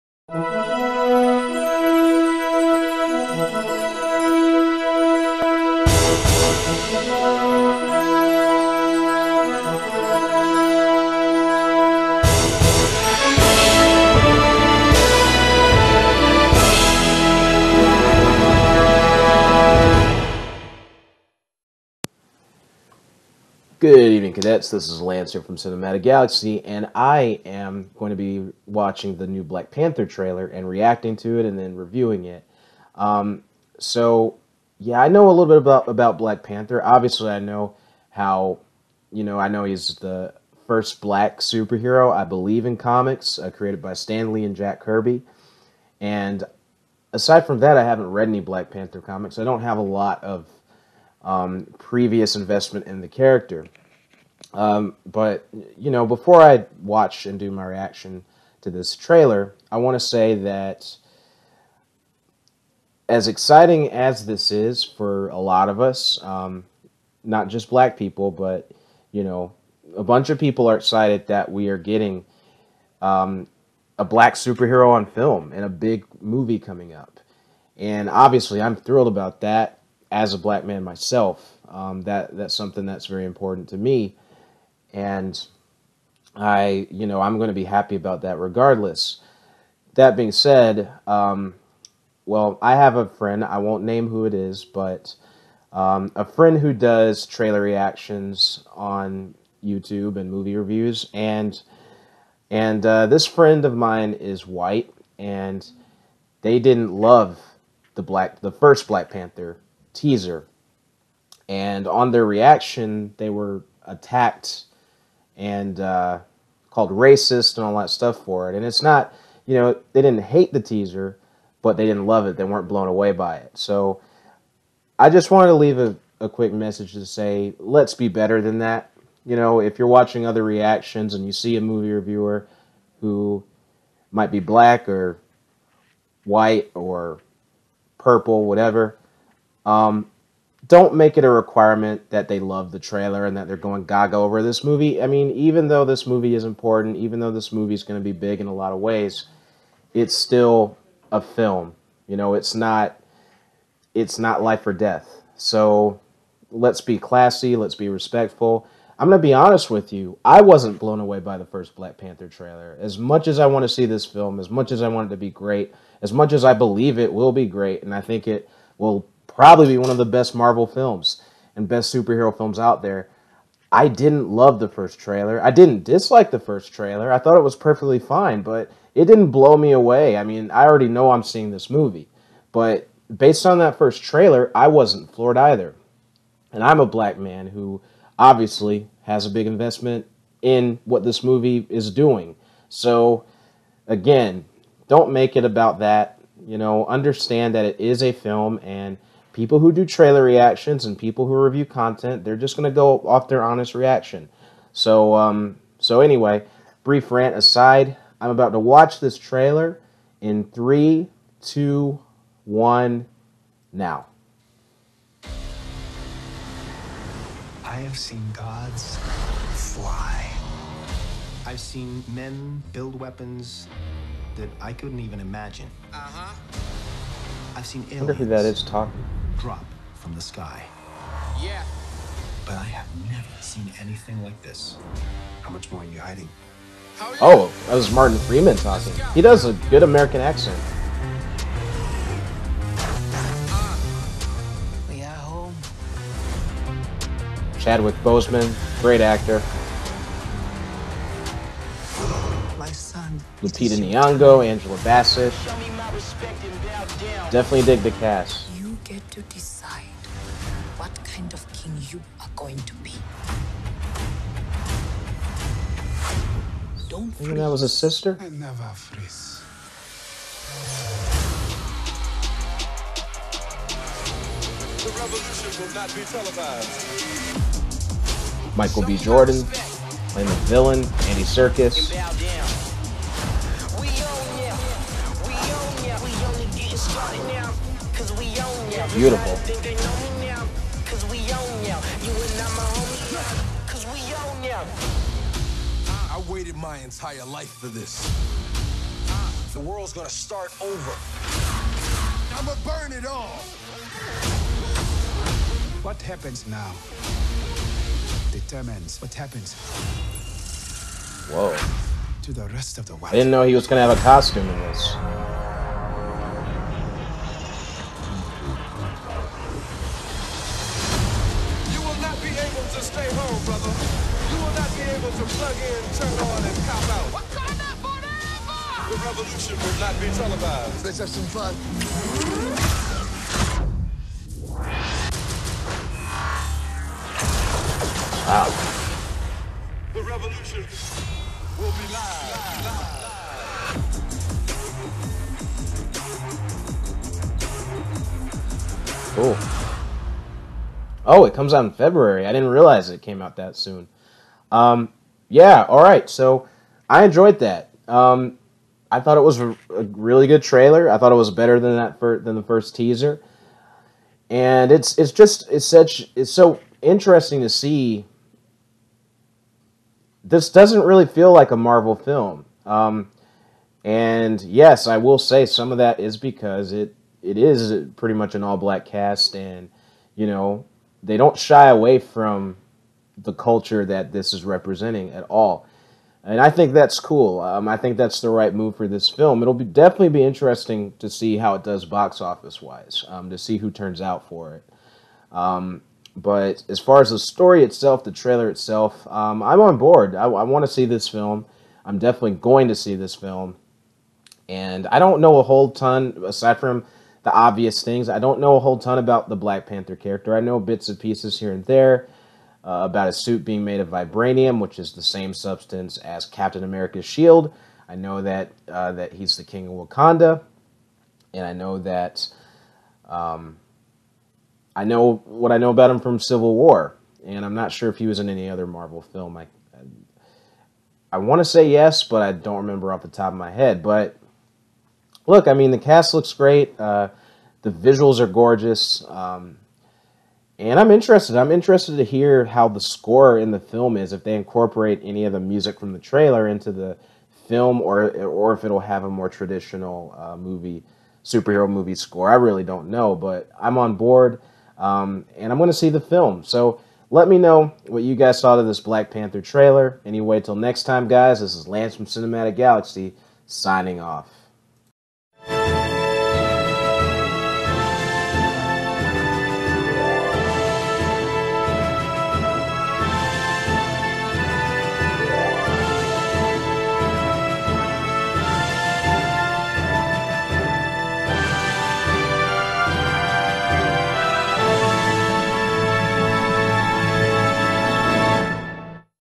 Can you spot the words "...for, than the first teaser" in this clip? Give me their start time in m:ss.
6:01.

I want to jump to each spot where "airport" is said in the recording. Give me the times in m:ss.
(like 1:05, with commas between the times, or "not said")
not said.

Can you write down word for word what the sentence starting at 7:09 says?
I I, I want to say yes, but I don't remember off the top of my head.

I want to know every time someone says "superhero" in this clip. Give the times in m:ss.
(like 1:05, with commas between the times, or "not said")
0:41, 1:14, 2:51, 7:31.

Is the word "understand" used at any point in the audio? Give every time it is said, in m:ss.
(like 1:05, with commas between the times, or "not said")
3:16.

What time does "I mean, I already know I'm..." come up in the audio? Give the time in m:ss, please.
3:00.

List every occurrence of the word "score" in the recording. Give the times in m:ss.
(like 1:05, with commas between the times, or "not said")
7:22, 7:31.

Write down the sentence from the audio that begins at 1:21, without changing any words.
Um, that that's something that's very important to me and I, you know, I'm going to be happy about that regardless.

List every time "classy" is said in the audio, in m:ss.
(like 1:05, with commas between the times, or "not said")
2:36.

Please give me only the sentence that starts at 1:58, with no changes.
And it's not, you know, they didn't hate the teaser, but they didn't love it.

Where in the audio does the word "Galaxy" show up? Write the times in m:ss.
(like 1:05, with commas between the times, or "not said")
0:26, 7:42.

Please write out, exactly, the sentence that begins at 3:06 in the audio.
And I'm a black man who obviously has a big investment in what this movie is doing.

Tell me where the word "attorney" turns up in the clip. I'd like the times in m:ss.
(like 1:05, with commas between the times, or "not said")
not said.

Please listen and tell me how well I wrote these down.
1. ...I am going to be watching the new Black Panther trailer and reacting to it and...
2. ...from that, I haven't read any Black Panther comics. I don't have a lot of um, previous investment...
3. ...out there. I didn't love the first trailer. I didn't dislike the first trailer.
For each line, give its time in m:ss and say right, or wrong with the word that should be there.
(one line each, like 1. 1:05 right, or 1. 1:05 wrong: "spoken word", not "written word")
1. 0:26 right
2. 0:47 right
3. 2:52 right.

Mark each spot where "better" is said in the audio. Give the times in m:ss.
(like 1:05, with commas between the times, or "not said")
2:08, 6:01.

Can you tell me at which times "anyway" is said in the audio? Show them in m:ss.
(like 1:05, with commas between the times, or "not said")
3:26, 7:40.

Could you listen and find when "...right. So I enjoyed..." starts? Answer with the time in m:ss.
5:55.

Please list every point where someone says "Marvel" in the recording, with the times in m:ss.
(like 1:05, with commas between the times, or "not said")
2:50, 6:11, 7:08.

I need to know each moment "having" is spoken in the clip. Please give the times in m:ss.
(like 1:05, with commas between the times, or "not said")
not said.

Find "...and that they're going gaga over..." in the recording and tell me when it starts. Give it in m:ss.
2:23.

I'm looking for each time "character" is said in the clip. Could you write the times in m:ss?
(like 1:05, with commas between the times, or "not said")
0:53, 6:49.